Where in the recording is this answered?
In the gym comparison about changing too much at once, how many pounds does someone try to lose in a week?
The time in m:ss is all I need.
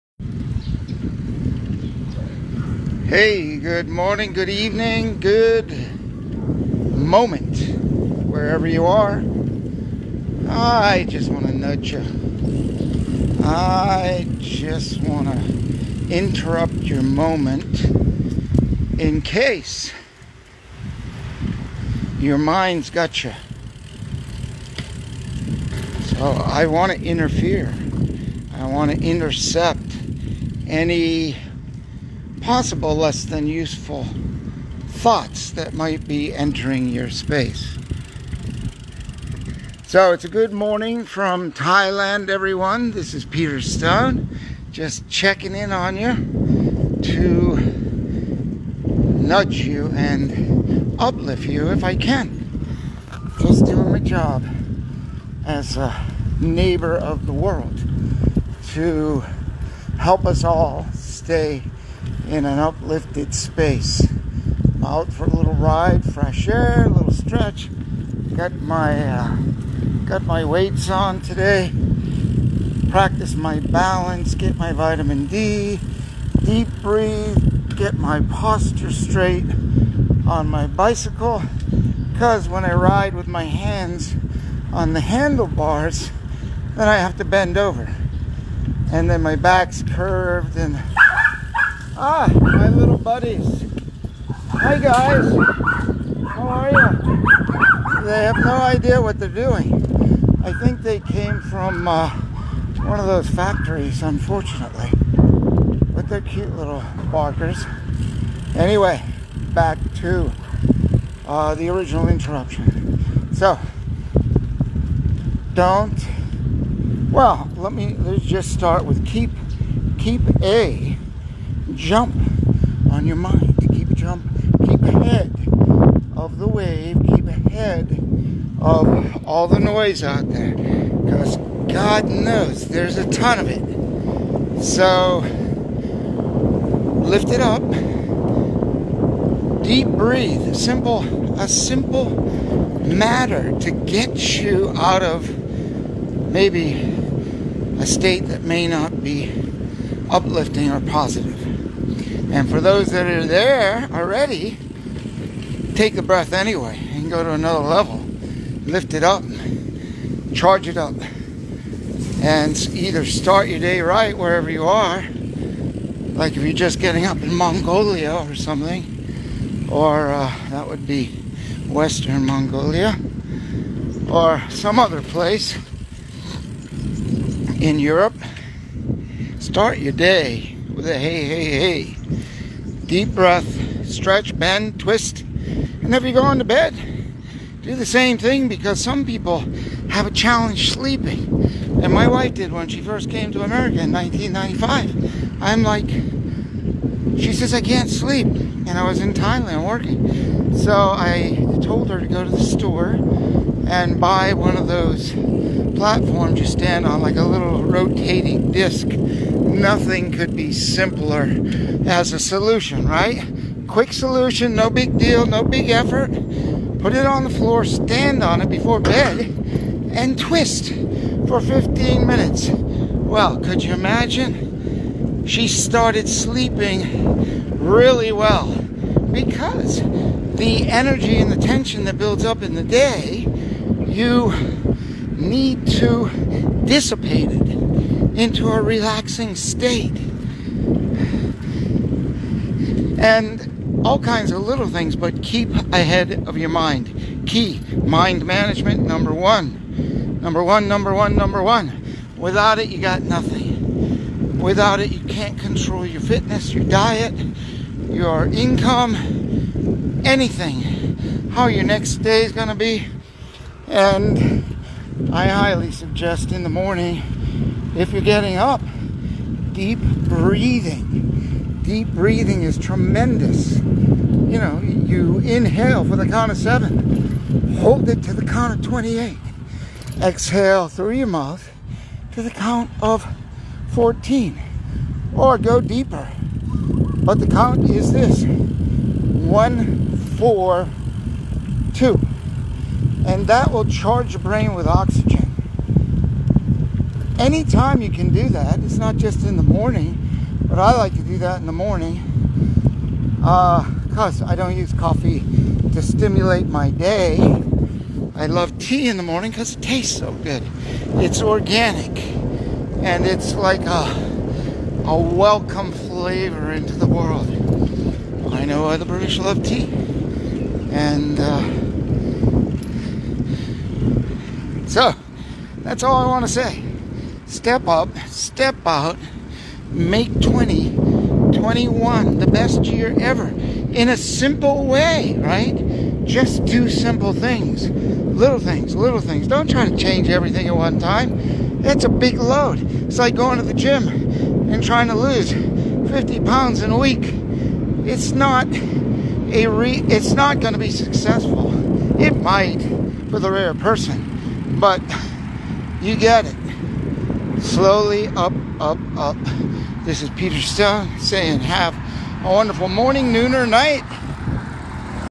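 5:45.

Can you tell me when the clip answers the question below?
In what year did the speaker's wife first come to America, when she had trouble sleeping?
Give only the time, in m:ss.
3:13.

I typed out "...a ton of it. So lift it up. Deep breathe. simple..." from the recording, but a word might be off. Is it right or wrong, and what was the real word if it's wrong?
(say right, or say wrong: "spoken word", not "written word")
right.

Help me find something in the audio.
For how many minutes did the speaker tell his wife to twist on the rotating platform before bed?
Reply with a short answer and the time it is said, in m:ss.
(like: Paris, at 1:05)
15 minutes, at 3:41.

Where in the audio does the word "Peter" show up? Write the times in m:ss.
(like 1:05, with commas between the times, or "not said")
0:43, 6:00.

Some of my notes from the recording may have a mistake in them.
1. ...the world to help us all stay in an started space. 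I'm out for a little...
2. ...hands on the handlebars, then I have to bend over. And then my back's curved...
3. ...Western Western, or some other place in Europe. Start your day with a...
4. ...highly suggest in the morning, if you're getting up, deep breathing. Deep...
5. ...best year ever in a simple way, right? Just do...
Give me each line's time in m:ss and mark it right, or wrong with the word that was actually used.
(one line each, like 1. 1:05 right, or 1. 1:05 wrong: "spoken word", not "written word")
1. 0:57 wrong: "uplifted", not "started"
2. 1:23 right
3. 2:51 wrong: "Mongolia", not "Western"
4. 4:25 right
5. 5:32 right.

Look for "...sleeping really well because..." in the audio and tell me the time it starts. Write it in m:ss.
3:46.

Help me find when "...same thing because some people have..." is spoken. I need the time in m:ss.
3:07.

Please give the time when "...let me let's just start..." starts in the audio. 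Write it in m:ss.
1:57.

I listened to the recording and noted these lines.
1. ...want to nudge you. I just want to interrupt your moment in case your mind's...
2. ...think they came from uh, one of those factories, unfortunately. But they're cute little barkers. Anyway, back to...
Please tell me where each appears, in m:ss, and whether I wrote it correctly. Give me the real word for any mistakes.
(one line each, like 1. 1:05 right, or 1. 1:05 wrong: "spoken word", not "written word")
1. 0:11 right
2. 1:40 right.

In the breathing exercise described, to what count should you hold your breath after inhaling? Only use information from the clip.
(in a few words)
28.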